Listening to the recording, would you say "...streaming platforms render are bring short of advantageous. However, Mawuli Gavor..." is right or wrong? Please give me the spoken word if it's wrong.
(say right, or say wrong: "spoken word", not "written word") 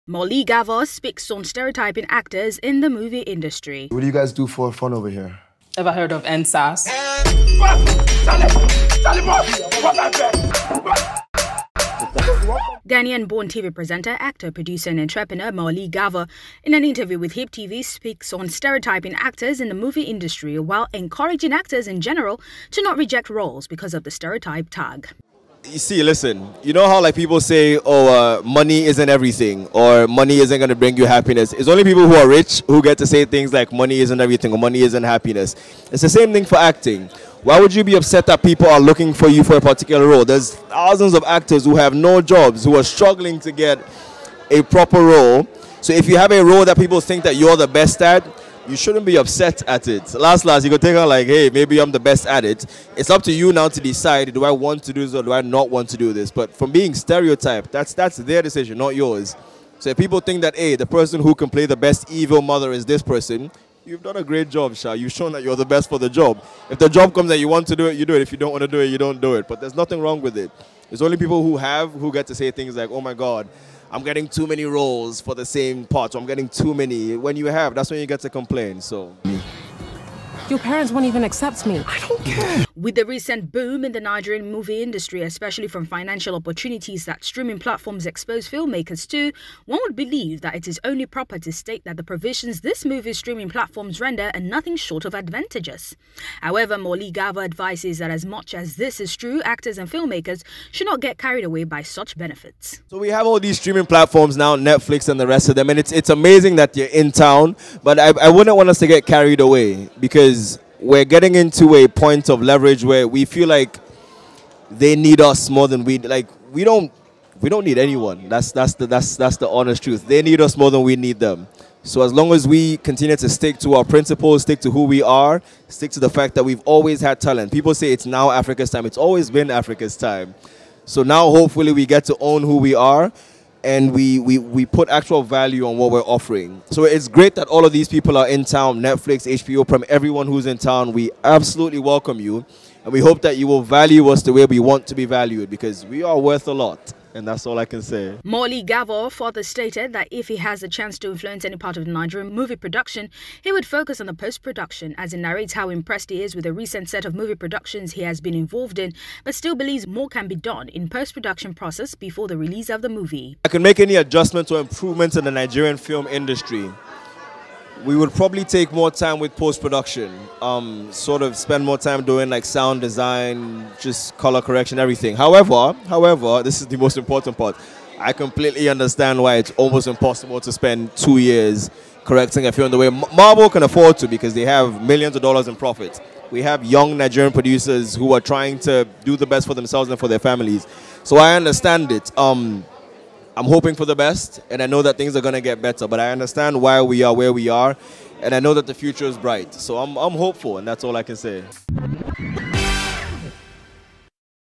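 wrong: "nothing", not "bring".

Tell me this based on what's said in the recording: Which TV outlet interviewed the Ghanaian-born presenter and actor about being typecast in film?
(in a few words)
HIP TV.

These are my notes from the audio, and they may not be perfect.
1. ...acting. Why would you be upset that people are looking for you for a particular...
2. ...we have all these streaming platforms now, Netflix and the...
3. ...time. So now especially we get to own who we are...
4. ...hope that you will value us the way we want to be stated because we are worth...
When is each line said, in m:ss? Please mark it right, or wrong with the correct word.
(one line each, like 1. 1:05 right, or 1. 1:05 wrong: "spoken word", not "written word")
1. 0:36 right
2. 1:42 right
3. 2:09 wrong: "hopefully", not "especially"
4. 2:22 wrong: "valued", not "stated".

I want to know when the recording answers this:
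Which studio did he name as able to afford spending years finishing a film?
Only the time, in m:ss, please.
3:02.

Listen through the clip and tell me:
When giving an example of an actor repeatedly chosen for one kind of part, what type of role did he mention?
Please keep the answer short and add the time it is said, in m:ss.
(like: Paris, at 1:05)
Evil mother, at 1:02.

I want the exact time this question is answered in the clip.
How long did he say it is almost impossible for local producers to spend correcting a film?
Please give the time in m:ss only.
3:00.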